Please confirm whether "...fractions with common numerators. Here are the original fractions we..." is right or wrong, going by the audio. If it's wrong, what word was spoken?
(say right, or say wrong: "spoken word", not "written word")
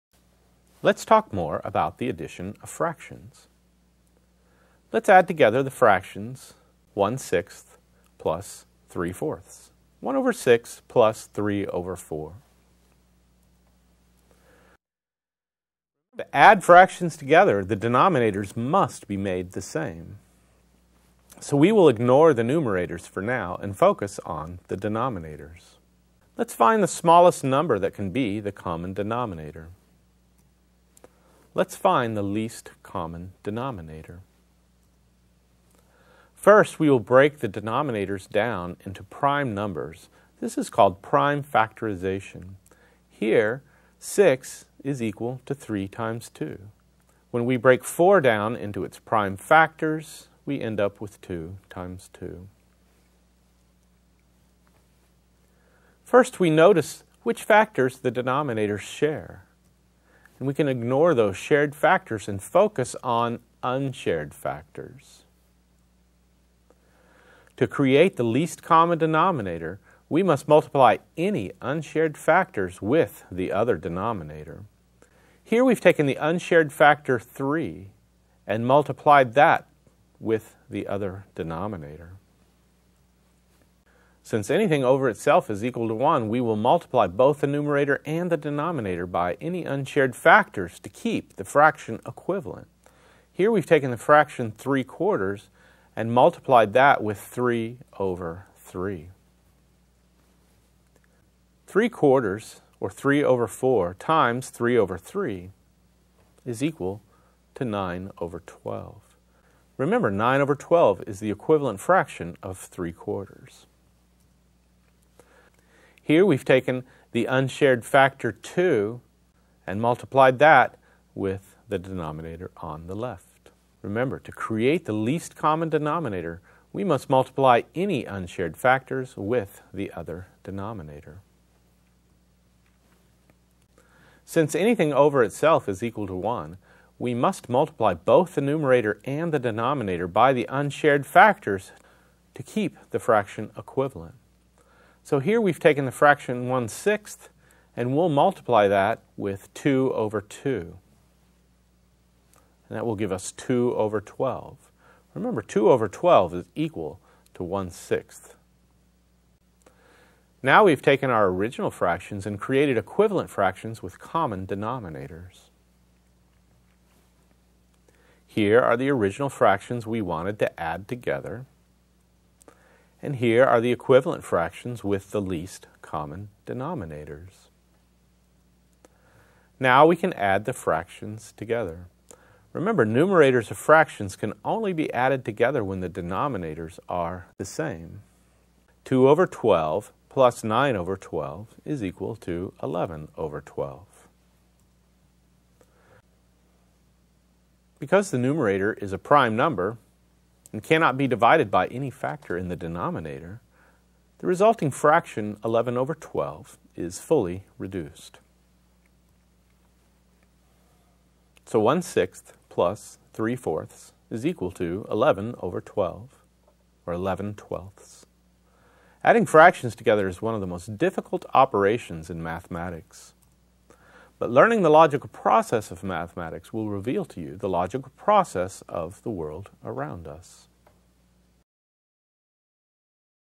wrong: "denominators", not "numerators".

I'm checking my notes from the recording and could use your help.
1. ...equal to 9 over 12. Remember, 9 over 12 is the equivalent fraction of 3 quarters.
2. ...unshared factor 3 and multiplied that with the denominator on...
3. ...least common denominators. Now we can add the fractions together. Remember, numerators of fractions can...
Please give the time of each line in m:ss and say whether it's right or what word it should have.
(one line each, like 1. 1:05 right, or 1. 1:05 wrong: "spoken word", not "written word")
1. 1:46 right
2. 1:57 wrong: "2", not "3"
3. 2:55 right.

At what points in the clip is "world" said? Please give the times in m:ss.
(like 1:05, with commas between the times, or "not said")
3:49.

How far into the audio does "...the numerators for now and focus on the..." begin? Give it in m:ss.
0:22.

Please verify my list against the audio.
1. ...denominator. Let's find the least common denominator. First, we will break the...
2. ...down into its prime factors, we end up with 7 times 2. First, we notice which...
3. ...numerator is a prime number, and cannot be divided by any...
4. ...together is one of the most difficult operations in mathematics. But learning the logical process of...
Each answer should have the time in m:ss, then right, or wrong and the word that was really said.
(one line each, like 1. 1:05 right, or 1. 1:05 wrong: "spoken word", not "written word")
1. 0:28 right
2. 0:48 wrong: "2", not "7"
3. 3:18 right
4. 3:39 right.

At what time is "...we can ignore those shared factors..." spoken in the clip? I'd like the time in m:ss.
1:00.